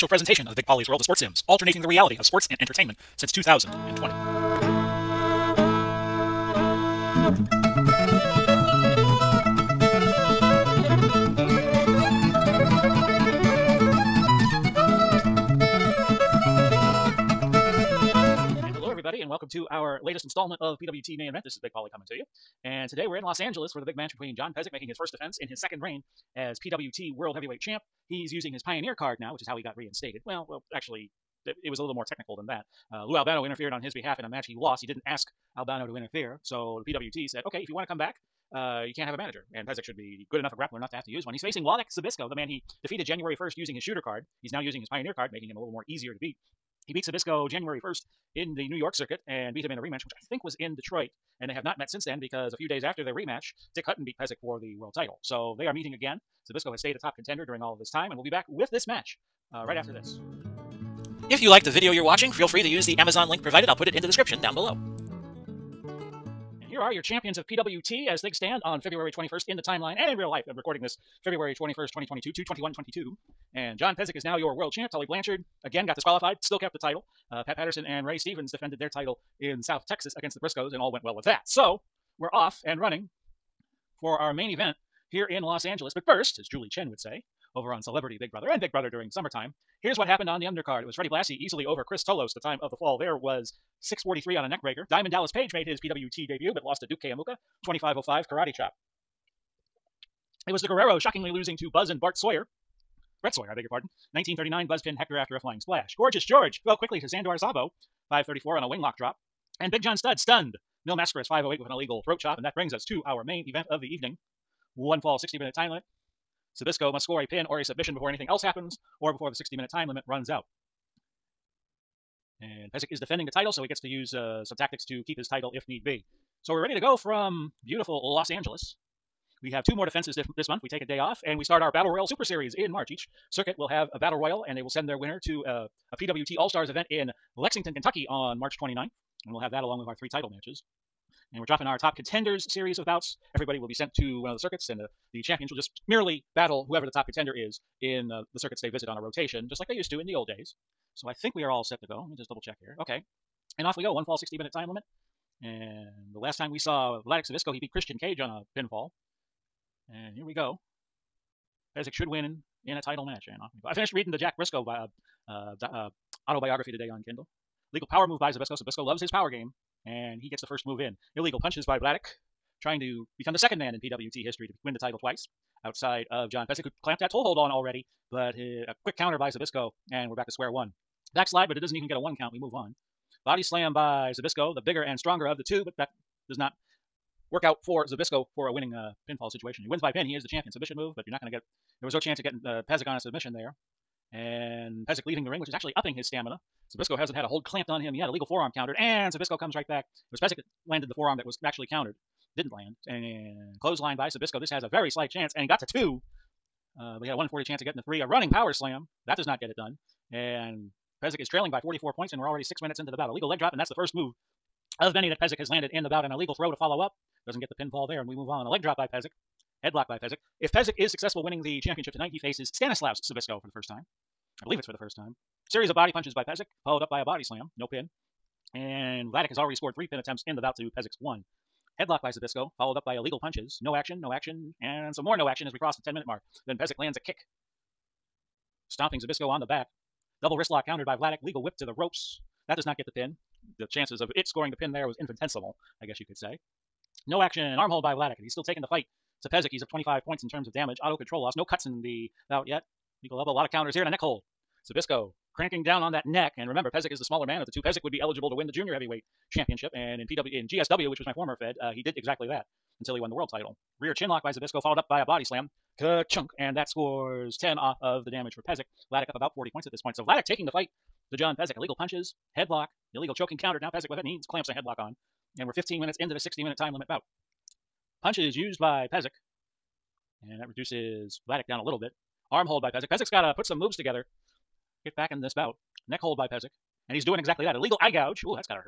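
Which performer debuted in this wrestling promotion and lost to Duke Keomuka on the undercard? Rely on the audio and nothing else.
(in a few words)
Diamond Dallas Page.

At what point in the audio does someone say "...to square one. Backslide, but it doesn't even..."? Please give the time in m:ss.
3:00.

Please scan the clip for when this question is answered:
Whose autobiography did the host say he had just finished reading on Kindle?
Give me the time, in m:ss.
2:44.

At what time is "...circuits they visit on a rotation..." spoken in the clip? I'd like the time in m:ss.
2:28.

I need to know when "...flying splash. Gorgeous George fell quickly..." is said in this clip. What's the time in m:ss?
1:45.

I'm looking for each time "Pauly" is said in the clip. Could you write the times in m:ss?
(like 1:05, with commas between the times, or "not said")
0:00, 0:21.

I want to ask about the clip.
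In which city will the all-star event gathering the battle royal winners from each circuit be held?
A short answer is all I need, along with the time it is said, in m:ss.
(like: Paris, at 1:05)
Lexington, Kentucky, at 2:17.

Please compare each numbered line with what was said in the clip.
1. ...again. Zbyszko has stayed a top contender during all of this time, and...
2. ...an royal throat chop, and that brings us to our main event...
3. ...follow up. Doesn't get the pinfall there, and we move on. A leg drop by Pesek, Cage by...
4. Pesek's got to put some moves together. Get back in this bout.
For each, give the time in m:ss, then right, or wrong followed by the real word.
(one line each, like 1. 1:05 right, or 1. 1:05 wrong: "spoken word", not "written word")
1. 0:55 right
2. 1:51 wrong: "illegal", not "royal"
3. 3:36 wrong: "Headlock", not "Cage"
4. 4:42 right.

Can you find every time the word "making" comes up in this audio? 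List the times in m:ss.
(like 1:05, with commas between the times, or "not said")
0:24, 0:45.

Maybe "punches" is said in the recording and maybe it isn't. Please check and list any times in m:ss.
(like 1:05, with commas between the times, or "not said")
2:51, 3:45, 3:53, 4:31, 4:38.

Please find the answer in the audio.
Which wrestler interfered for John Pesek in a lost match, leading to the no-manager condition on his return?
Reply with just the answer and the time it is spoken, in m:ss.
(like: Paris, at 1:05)
Lou Albano, at 0:33.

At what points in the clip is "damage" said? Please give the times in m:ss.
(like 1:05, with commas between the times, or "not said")
4:10, 4:28.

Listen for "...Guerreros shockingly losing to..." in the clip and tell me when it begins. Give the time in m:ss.
1:40.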